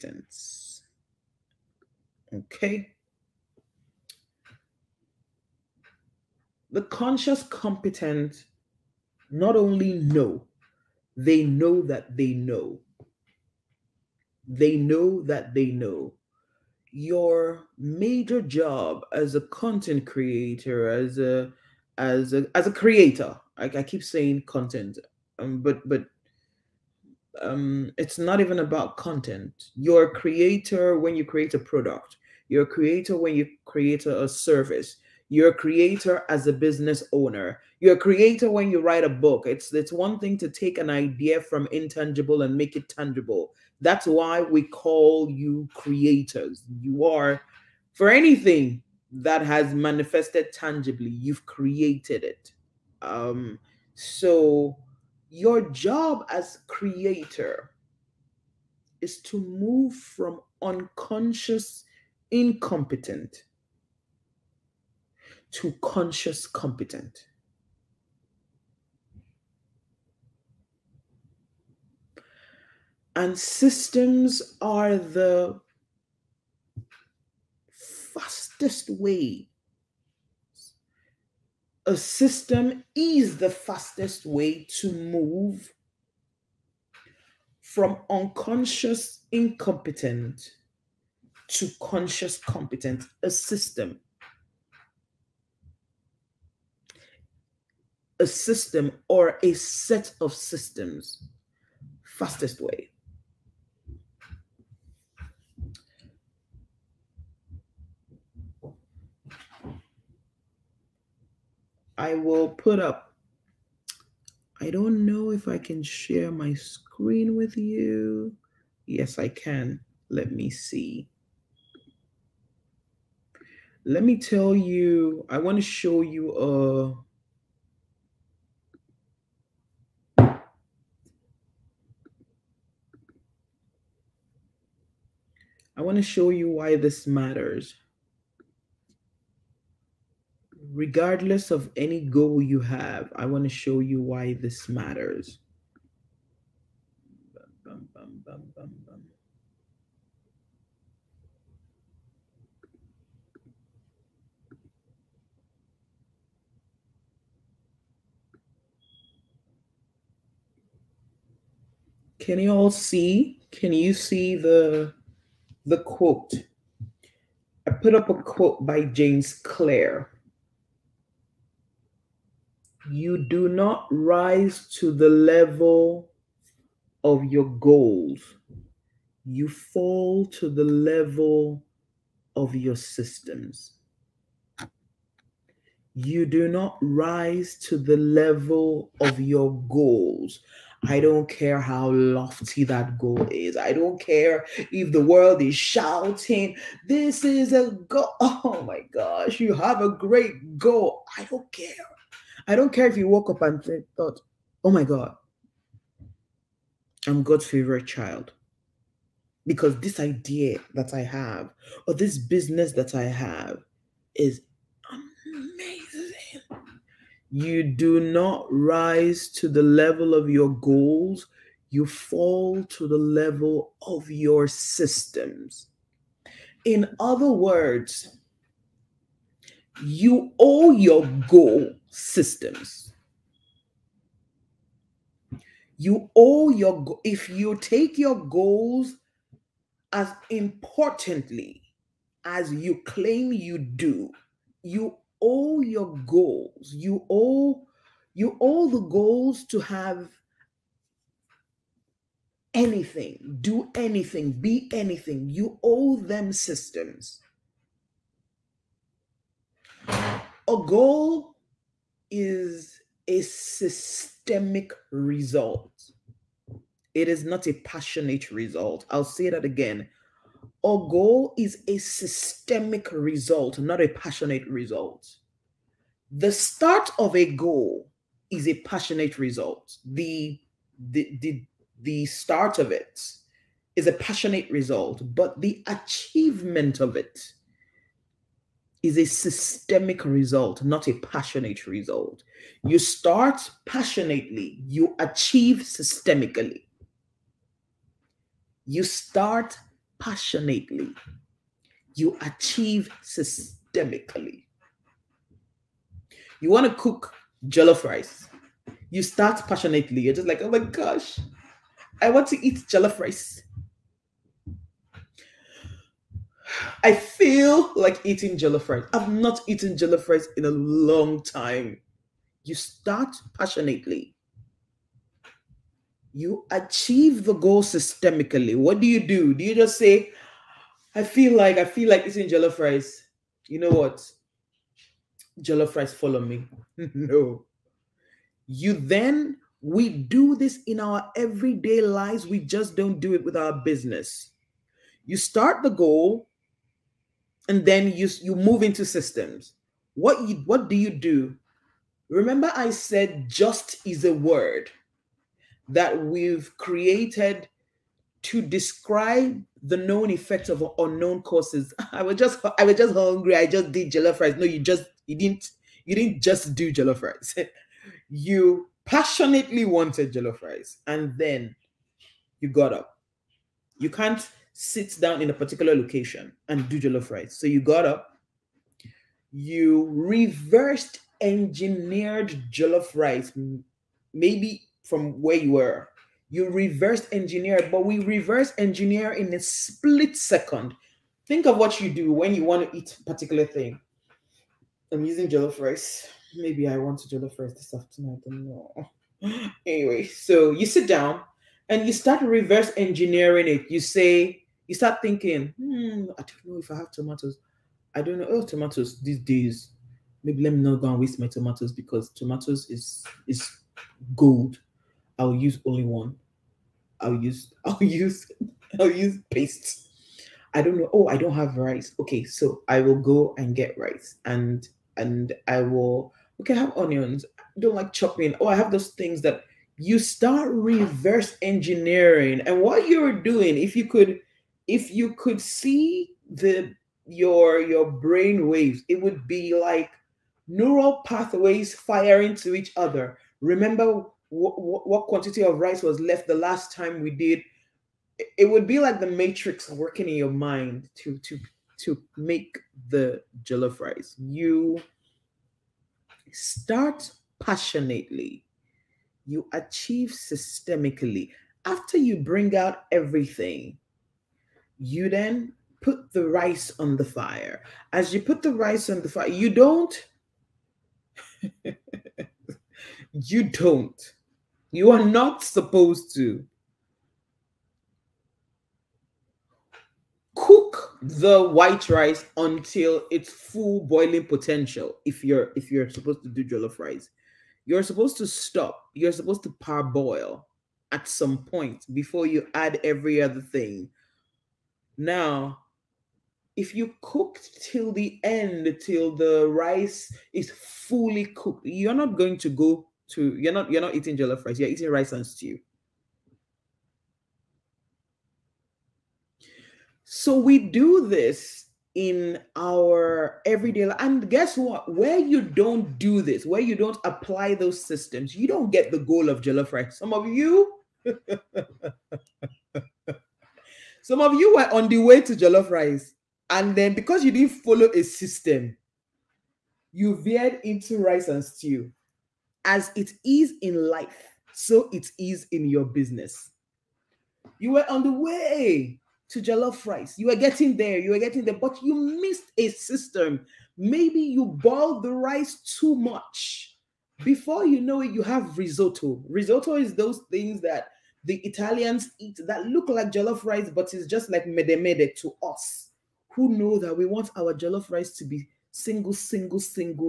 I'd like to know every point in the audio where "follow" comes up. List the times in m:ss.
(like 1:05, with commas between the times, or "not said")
5:35, 8:47.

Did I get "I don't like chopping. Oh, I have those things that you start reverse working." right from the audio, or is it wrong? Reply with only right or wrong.
wrong.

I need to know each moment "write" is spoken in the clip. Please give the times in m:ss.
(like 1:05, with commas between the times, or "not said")
0:38.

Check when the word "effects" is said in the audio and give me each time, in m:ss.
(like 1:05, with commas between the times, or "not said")
6:00.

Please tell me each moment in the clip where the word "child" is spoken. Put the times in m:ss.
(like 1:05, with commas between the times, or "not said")
3:27.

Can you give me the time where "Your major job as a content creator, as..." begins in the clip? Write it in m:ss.
0:16.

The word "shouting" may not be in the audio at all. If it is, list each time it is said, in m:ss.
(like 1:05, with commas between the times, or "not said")
3:15.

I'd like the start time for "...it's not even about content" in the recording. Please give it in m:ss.
0:27.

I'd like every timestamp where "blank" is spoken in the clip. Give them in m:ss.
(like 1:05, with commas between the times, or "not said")
not said.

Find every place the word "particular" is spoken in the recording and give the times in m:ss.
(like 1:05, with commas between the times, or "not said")
6:15, 6:33.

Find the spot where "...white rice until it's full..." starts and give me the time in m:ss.
8:01.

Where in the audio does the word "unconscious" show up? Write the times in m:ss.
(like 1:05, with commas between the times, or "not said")
1:00, 1:28.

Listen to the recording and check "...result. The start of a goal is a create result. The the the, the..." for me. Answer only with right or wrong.
wrong.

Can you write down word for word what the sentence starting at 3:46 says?
In other words, you owe your goal systems.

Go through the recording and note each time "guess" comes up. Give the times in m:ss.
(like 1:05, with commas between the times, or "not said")
8:34.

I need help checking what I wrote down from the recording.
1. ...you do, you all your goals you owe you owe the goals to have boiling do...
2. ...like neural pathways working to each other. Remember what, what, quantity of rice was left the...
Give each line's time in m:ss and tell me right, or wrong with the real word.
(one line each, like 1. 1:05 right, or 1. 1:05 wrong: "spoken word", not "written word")
1. 4:03 wrong: "anything", not "boiling"
2. 7:19 wrong: "firing", not "working".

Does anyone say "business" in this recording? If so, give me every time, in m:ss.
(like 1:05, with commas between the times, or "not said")
0:36, 3:32, 5:43, 8:55.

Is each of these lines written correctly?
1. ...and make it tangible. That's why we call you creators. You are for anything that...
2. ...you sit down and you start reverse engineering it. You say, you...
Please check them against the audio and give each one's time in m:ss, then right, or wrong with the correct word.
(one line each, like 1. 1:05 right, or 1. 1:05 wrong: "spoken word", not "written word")
1. 0:42 right
2. 6:40 right.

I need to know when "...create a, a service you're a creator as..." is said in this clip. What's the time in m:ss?
0:33.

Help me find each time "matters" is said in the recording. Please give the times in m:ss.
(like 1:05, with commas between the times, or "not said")
2:17, 2:24.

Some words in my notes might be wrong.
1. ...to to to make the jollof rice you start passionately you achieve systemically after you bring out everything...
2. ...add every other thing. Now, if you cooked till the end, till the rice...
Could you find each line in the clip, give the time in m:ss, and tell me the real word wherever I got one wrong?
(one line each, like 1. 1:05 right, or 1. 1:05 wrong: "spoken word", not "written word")
1. 7:30 right
2. 8:12 right.